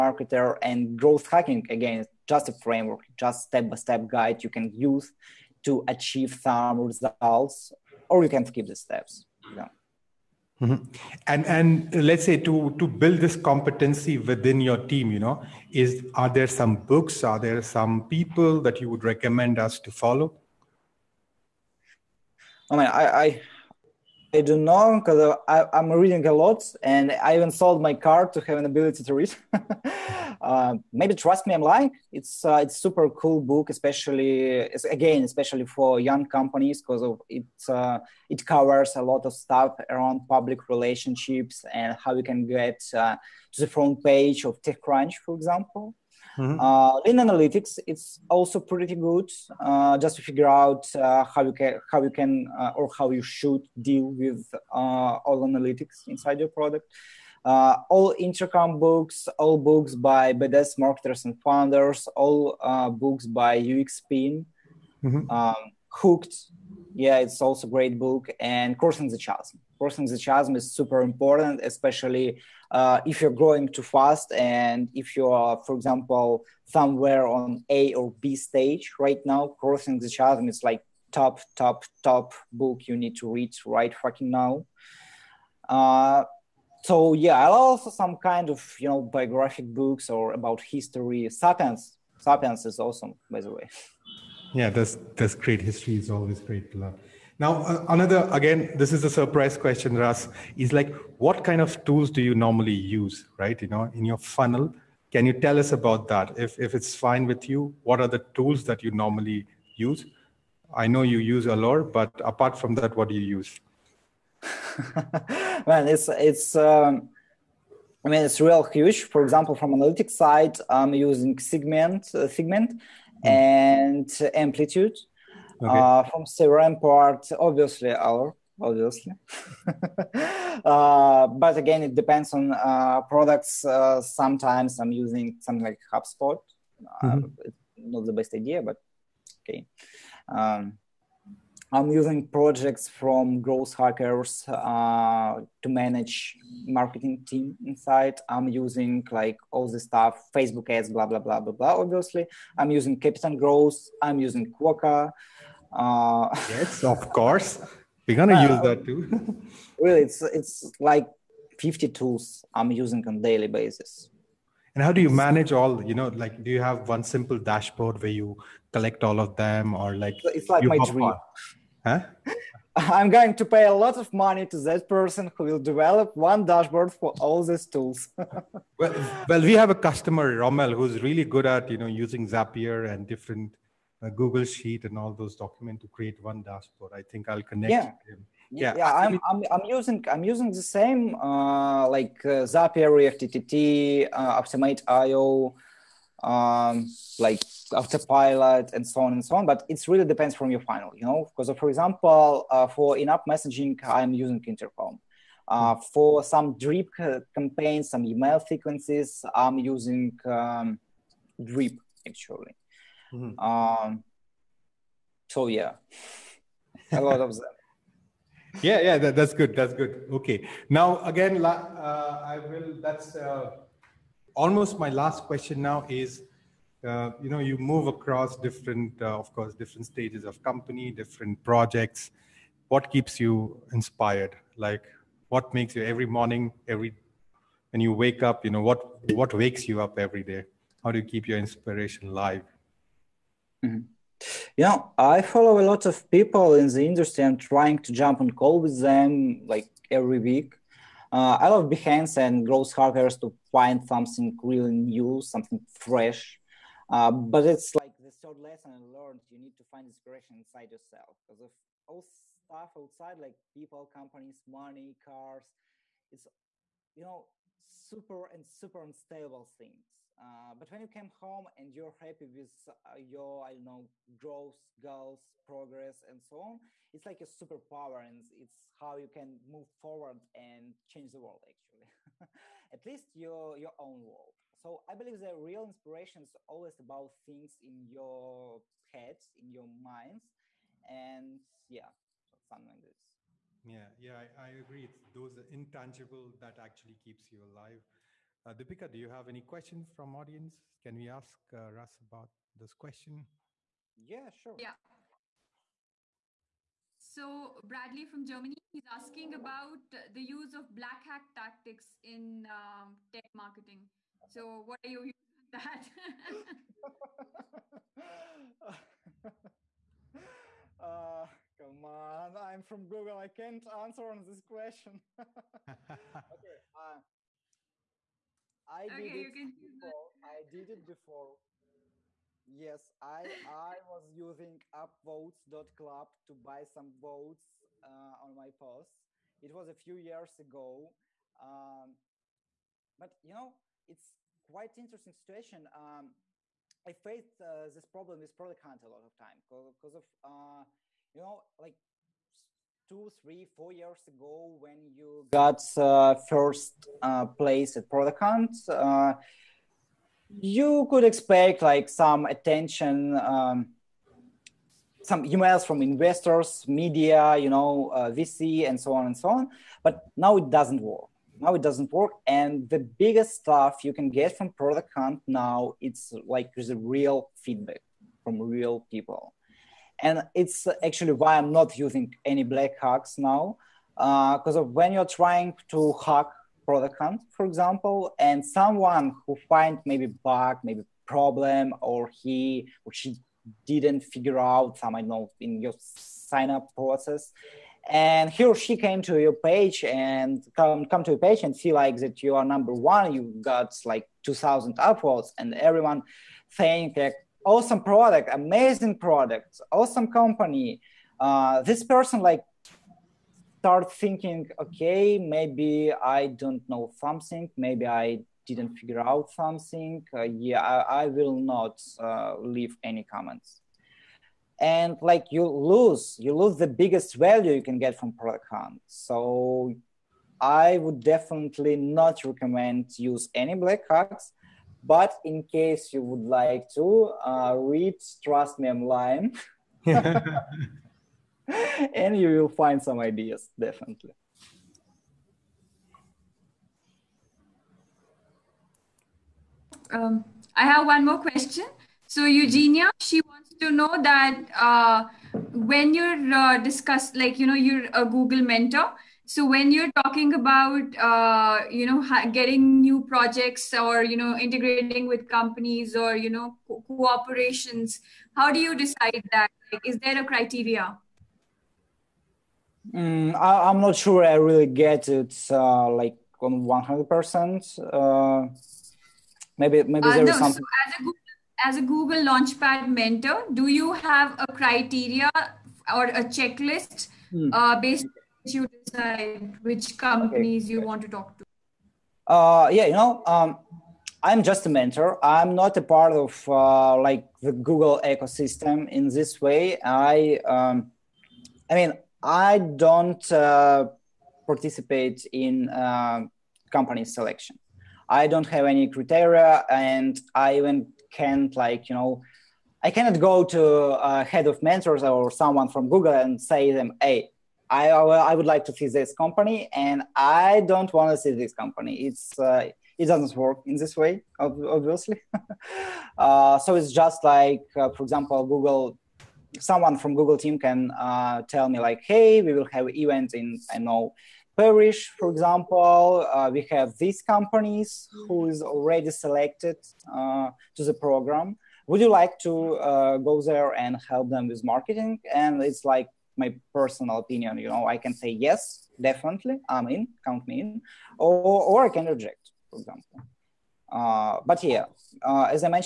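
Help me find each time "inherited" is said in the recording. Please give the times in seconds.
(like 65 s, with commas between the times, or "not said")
not said.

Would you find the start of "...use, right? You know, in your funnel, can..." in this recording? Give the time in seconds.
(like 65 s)
102 s.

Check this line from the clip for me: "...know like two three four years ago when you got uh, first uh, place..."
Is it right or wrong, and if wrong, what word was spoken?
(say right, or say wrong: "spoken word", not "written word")
right.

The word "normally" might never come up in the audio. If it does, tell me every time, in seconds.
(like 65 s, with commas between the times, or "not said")
102 s, 108 s.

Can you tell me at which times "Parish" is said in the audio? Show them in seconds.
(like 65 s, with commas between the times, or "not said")
534 s.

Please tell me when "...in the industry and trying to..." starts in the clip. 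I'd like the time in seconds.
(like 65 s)
246 s.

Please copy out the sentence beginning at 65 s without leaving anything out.
um, Hooked, yeah, it's also a great book.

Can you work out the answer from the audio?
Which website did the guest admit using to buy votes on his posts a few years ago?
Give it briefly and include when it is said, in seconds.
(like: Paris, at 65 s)
upvotes.club, at 334 s.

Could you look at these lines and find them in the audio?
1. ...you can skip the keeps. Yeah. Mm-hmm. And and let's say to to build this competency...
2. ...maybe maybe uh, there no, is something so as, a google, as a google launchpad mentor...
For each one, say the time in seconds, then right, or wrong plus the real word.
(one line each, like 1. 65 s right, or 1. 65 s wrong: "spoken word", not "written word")
1. 8 s wrong: "steps", not "keeps"
2. 479 s right.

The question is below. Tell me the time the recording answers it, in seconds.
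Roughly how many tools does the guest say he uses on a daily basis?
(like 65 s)
161 s.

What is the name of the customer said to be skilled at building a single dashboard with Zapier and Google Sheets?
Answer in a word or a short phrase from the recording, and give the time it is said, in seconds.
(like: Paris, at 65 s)
Rommel, at 180 s.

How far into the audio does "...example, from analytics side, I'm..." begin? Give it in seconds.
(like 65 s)
119 s.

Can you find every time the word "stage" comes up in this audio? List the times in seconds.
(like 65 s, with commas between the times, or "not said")
78 s, 229 s.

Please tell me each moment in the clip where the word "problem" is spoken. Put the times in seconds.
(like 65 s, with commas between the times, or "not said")
347 s, 391 s.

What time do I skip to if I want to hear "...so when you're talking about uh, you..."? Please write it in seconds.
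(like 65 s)
459 s.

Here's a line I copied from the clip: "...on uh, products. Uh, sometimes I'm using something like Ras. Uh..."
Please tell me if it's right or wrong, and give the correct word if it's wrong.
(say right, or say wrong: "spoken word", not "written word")
wrong: "HubSpot", not "Ras".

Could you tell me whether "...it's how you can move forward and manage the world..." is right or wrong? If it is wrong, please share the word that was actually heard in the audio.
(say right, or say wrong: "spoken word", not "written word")
wrong: "change", not "manage".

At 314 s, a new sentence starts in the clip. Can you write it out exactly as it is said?
So what are you using that?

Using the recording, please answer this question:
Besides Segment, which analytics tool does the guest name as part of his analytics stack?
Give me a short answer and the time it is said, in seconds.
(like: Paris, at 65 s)
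Amplitude, at 124 s.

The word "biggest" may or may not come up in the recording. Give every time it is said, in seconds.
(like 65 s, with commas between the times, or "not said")
373 s, 426 s.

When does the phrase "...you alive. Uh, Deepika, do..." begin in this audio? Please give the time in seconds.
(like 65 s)
297 s.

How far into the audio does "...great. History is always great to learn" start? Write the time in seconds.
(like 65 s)
95 s.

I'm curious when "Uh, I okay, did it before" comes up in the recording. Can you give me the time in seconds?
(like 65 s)
326 s.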